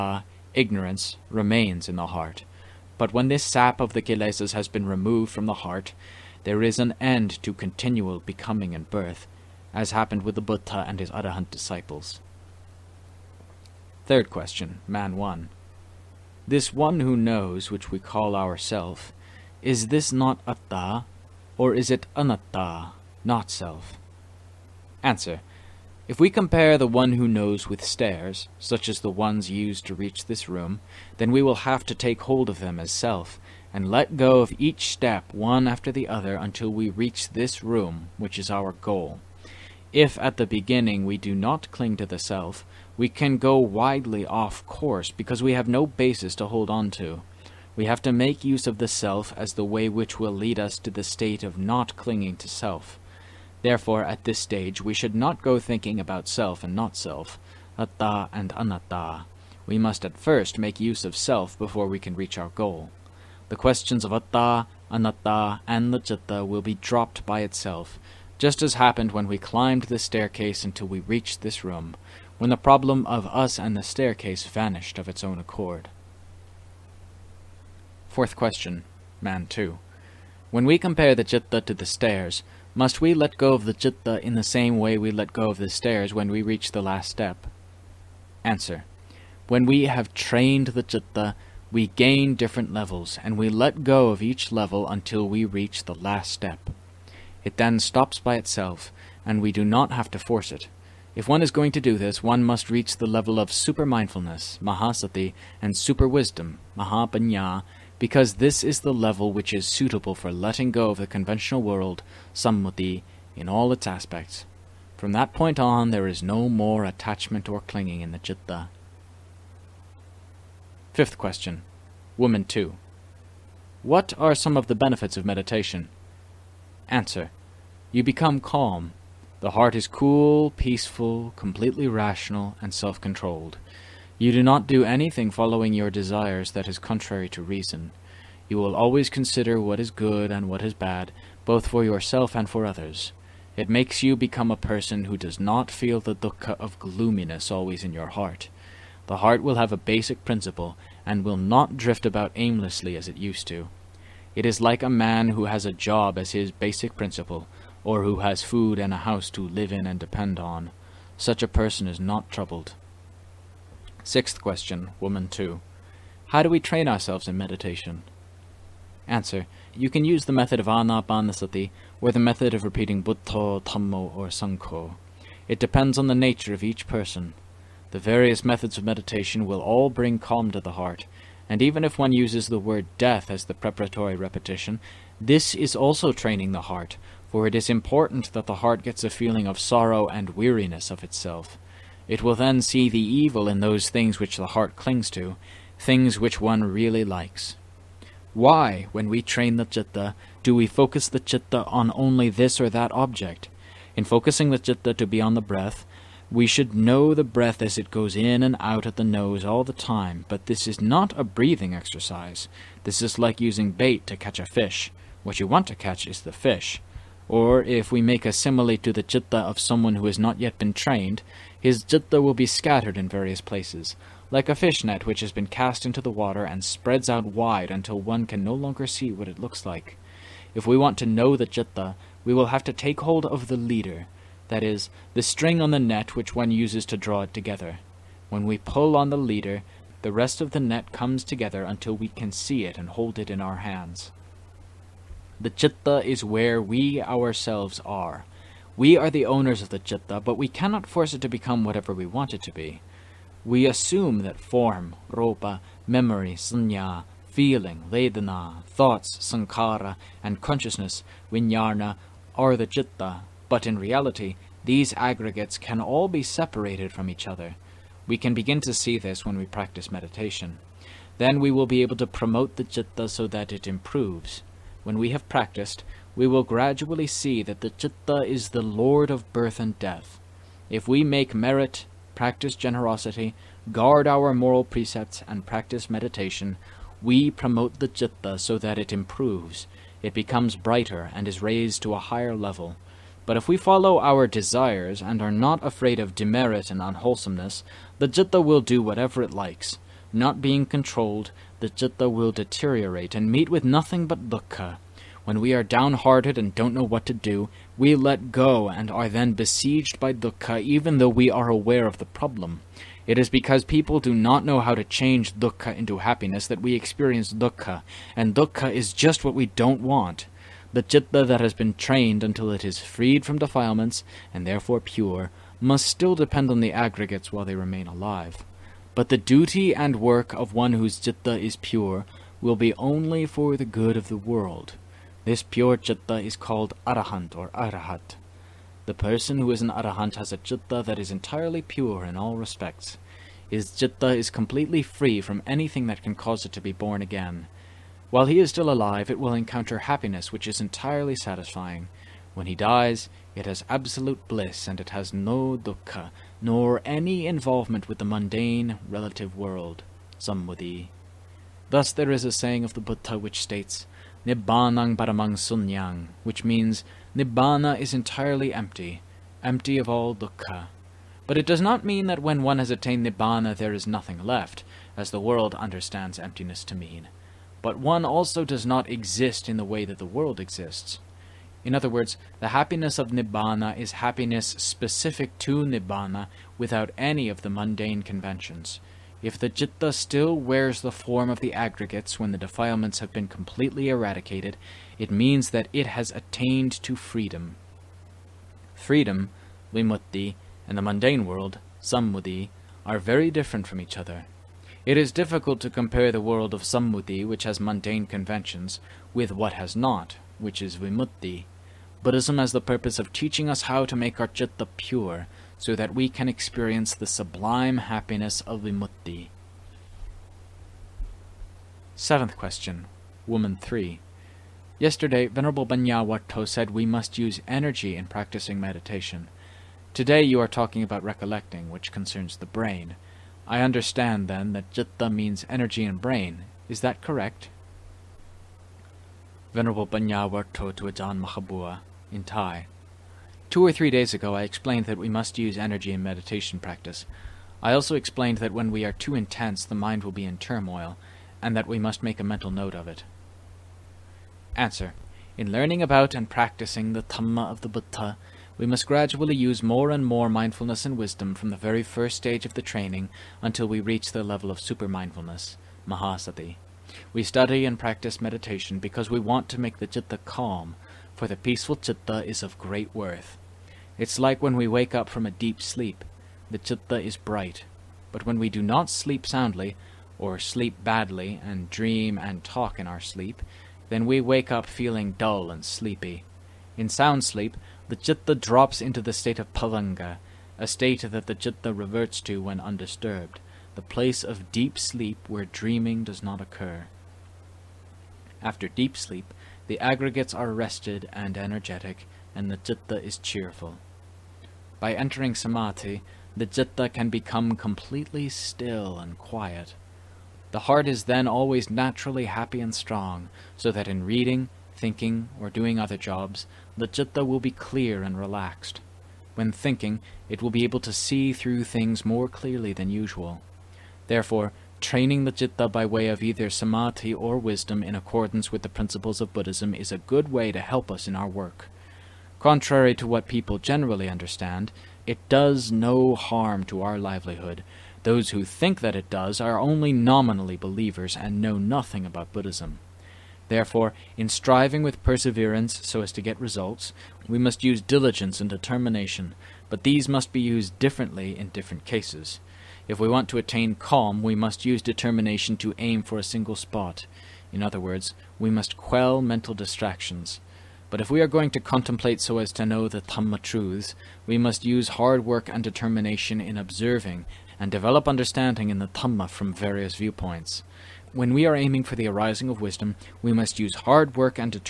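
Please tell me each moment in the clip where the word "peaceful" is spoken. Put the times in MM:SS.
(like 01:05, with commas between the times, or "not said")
02:10, 07:51.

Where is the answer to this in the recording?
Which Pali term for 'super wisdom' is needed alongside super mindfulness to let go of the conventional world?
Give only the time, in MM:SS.
01:46.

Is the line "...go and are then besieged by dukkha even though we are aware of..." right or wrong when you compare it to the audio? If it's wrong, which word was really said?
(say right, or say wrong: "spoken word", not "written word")
right.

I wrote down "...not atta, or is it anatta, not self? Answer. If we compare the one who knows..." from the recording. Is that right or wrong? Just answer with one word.
right.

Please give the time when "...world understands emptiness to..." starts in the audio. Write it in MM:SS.
06:15.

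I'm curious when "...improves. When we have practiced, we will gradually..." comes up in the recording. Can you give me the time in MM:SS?
04:33.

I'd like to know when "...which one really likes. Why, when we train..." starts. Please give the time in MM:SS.
03:16.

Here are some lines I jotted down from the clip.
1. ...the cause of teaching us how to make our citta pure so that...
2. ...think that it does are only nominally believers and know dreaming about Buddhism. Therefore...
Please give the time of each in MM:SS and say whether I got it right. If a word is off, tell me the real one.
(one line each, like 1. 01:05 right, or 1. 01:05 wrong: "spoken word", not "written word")
1. 06:52 wrong: "purpose", not "cause"
2. 08:58 wrong: "nothing", not "dreaming".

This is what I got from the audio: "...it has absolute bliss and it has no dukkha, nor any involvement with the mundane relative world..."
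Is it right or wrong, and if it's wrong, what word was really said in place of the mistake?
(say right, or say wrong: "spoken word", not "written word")
right.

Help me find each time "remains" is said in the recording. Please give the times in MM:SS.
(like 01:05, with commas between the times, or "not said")
00:01, 05:27.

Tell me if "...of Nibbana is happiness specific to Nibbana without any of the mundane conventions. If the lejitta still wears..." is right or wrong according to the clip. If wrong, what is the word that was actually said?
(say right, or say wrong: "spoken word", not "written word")
wrong: "citta", not "lejitta".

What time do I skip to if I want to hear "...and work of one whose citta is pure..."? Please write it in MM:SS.
05:29.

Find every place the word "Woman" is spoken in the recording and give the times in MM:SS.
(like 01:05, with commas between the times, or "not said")
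02:02, 02:45, 07:03.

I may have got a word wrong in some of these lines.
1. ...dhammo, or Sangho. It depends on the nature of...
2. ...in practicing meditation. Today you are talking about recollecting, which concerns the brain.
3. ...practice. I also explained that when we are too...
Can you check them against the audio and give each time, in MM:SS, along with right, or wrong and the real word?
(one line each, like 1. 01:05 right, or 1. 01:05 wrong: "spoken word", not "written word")
1. 02:53 right
2. 07:07 right
3. 07:26 right.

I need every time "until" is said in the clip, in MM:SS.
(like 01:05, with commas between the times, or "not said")
00:36, 01:10, 01:34, 03:47, 04:01, 05:22, 07:43.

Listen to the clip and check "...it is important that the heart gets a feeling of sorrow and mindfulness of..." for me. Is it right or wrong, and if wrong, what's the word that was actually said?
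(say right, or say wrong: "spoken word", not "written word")
wrong: "weariness", not "mindfulness".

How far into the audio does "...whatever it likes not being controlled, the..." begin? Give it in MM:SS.
04:58.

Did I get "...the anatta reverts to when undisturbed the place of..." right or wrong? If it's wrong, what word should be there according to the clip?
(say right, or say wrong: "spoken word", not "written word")
wrong: "citta", not "anatta".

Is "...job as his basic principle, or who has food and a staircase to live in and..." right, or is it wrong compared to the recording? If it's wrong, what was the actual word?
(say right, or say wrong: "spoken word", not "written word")
wrong: "house", not "staircase".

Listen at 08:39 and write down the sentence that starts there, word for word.
When thinking, it will be able to see through things more clearly than usual.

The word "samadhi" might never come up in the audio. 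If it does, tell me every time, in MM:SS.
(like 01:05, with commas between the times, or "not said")
08:25, 08:46.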